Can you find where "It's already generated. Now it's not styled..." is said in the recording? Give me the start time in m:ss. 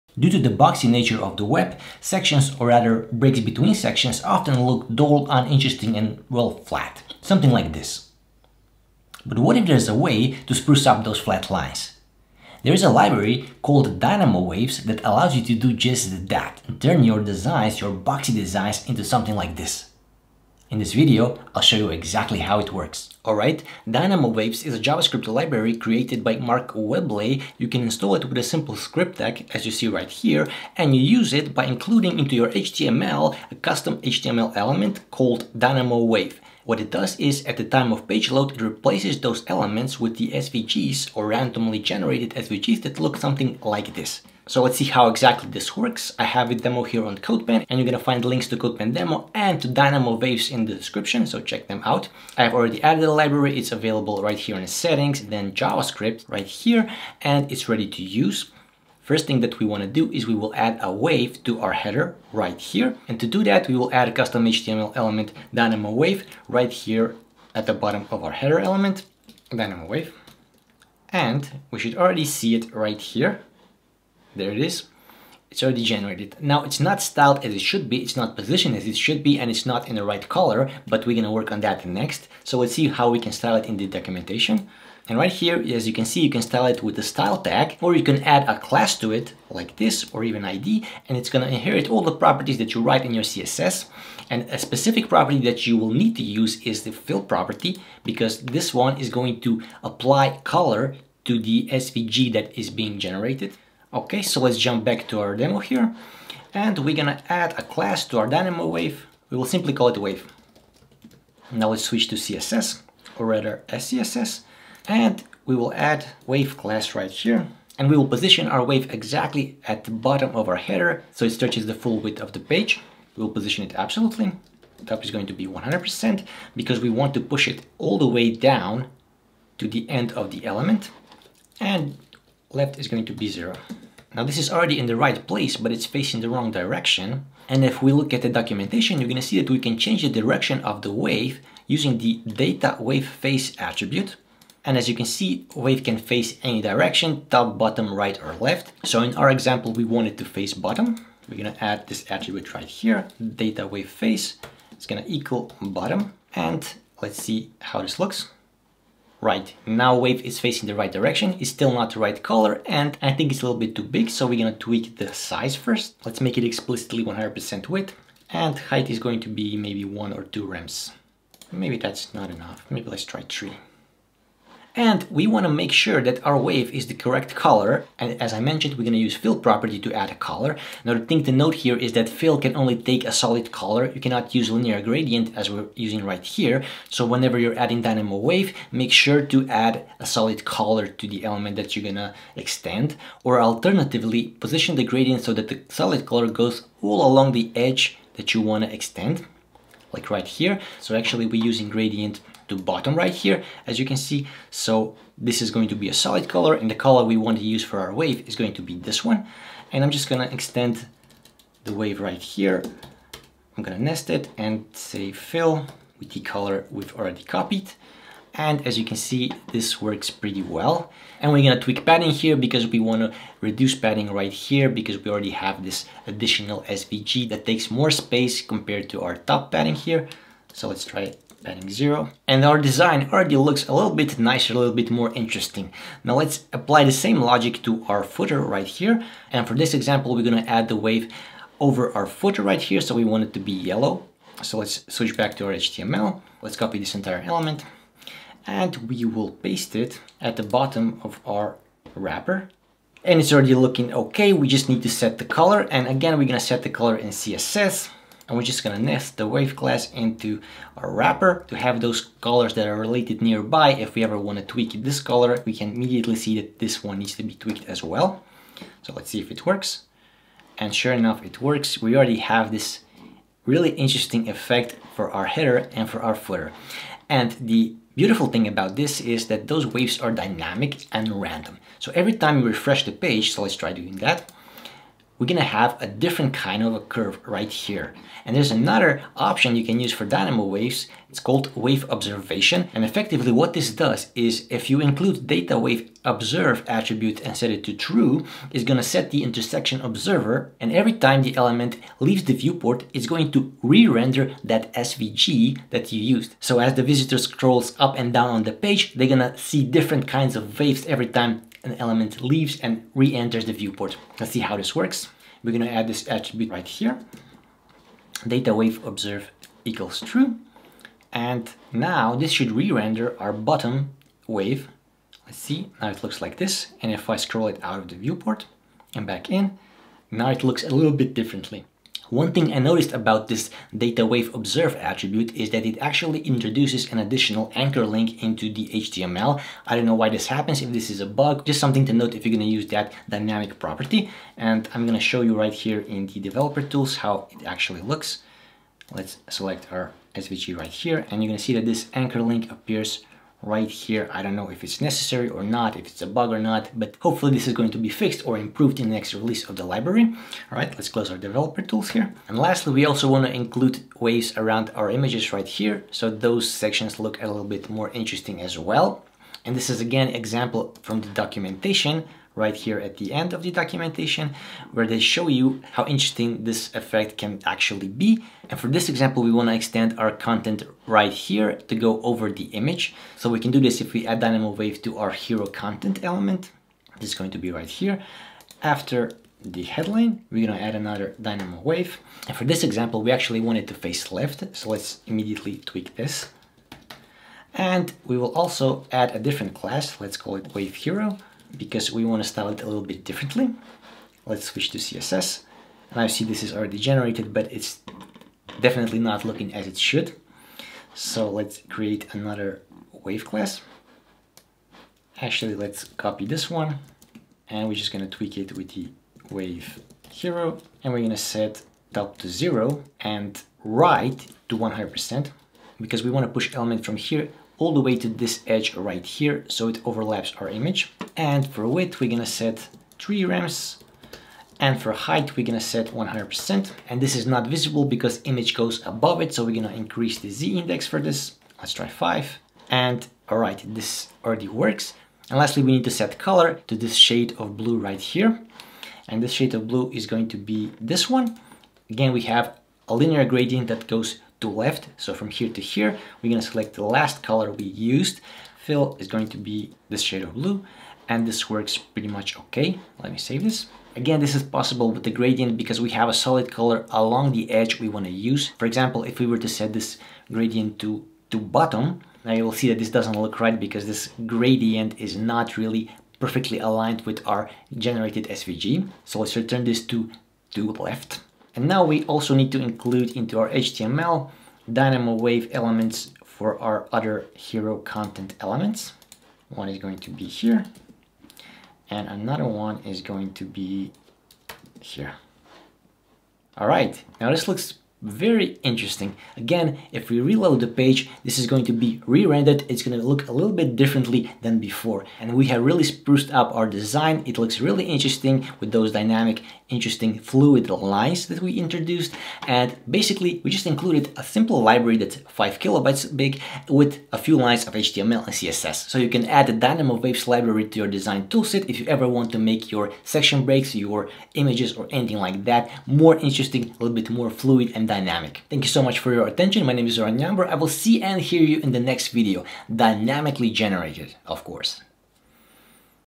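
1:15.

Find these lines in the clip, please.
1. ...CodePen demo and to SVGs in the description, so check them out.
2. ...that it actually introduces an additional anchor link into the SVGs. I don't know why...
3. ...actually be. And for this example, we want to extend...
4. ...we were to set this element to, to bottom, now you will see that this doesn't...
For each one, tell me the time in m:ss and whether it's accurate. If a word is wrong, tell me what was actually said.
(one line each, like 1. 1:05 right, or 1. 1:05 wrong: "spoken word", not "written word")
1. 0:48 wrong: "Dynamowaves", not "SVGs"
2. 5:35 wrong: "HTML", not "SVGs"
3. 6:17 right
4. 7:49 wrong: "gradient", not "element".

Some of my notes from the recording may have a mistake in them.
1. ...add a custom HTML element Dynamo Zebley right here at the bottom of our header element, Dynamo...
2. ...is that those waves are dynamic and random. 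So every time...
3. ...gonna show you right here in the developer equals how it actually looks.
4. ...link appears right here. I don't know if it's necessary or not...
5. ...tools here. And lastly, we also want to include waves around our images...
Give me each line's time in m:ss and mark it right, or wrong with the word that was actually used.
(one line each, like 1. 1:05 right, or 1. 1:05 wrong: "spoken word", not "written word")
1. 1:03 wrong: "Wave", not "Zebley"
2. 4:39 right
3. 5:44 wrong: "tools", not "equals"
4. 5:52 right
5. 6:01 right.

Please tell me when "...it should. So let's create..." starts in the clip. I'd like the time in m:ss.
6:49.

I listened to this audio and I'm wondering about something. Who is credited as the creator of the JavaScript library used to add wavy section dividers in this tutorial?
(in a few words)
Mark Zebley.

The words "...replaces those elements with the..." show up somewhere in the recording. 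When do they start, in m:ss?
0:38.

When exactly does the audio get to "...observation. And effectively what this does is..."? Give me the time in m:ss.
4:51.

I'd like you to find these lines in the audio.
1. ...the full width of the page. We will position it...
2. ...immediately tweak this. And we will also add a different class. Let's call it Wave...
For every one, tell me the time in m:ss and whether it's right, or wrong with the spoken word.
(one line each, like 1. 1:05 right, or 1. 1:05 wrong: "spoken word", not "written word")
1. 2:01 right
2. 6:35 right.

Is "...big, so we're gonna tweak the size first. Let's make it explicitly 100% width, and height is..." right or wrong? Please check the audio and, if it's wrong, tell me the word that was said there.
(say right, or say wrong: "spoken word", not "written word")
right.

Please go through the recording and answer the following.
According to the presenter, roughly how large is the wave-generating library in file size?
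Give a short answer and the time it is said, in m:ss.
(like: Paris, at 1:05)
5 kilobytes, at 8:35.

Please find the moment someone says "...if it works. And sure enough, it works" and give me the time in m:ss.
4:29.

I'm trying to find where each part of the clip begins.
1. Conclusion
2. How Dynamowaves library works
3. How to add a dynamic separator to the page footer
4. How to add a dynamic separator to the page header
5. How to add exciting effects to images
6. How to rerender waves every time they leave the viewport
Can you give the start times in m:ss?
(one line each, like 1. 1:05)
1. 8:25
2. 0:22
3. 3:55
4. 0:44
5. 6:02
6. 4:47.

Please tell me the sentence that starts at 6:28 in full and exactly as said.
After the headline, we're gonna add another Dynamo Wave.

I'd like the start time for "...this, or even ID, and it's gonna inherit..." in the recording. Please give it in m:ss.
1:29.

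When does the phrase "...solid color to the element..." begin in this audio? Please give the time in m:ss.
3:10.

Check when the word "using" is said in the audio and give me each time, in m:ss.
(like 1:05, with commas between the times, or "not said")
2:21, 3:05, 3:21.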